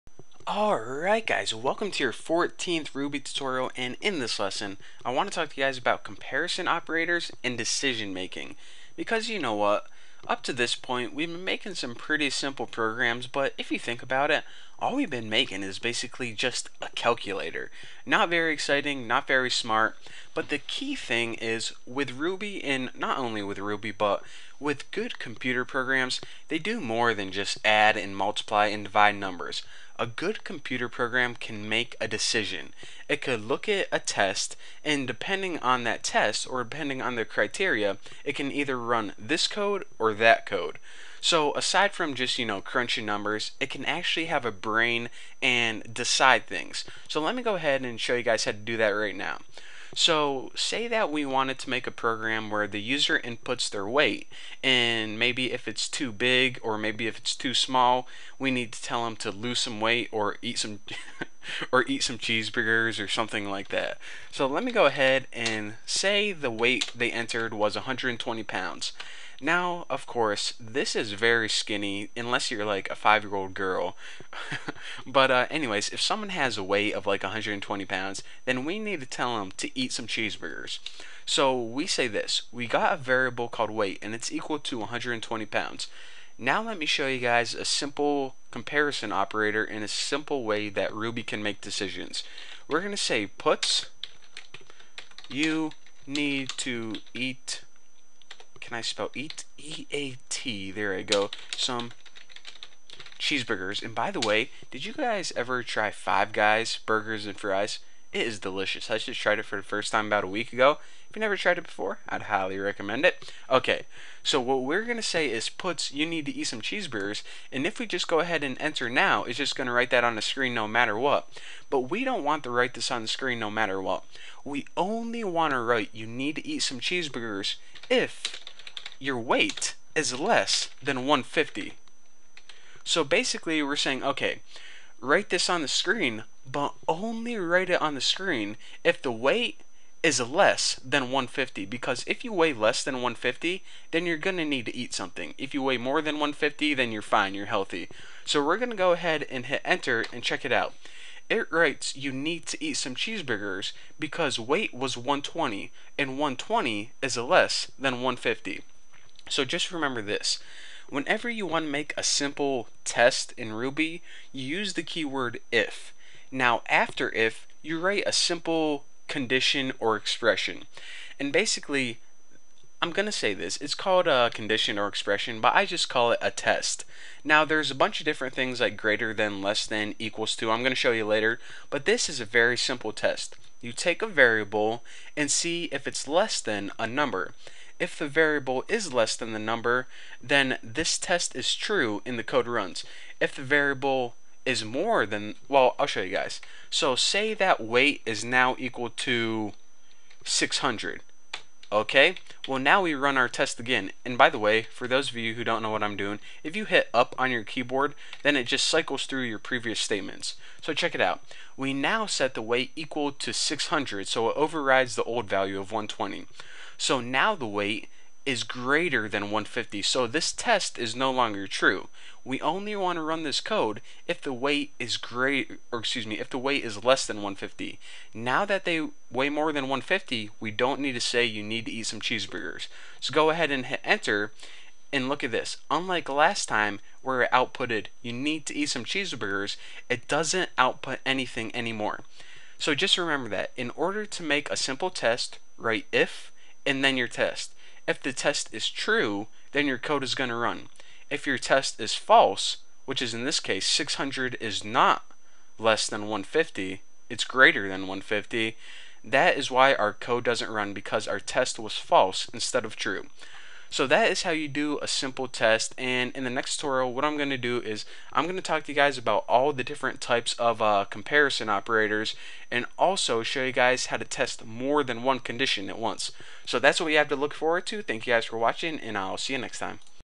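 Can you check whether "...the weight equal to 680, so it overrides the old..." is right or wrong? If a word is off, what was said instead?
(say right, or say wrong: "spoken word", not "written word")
wrong: "600", not "680".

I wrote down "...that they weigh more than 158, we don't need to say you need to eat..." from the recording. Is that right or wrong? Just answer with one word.
wrong.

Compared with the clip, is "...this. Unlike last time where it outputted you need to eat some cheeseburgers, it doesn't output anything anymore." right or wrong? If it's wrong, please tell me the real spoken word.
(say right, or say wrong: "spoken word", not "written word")
right.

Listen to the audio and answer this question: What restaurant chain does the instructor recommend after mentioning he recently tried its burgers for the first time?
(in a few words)
Five Guys.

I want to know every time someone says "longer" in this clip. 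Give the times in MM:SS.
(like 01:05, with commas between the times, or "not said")
03:41.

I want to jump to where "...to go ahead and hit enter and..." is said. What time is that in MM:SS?
02:28.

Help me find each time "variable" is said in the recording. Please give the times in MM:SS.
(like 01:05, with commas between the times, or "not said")
01:22, 03:04, 03:08, 03:13.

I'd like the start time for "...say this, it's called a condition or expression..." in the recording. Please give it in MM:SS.
02:53.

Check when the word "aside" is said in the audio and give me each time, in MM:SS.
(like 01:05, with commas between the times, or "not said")
00:41.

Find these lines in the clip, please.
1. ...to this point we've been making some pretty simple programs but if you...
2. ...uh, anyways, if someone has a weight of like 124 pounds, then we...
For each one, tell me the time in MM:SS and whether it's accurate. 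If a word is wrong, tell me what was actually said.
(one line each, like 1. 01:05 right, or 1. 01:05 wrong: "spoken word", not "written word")
1. 00:10 right
2. 01:15 wrong: "120", not "124".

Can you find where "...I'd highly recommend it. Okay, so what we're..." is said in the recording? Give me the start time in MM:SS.
01:52.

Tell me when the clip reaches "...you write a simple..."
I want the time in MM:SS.
02:47.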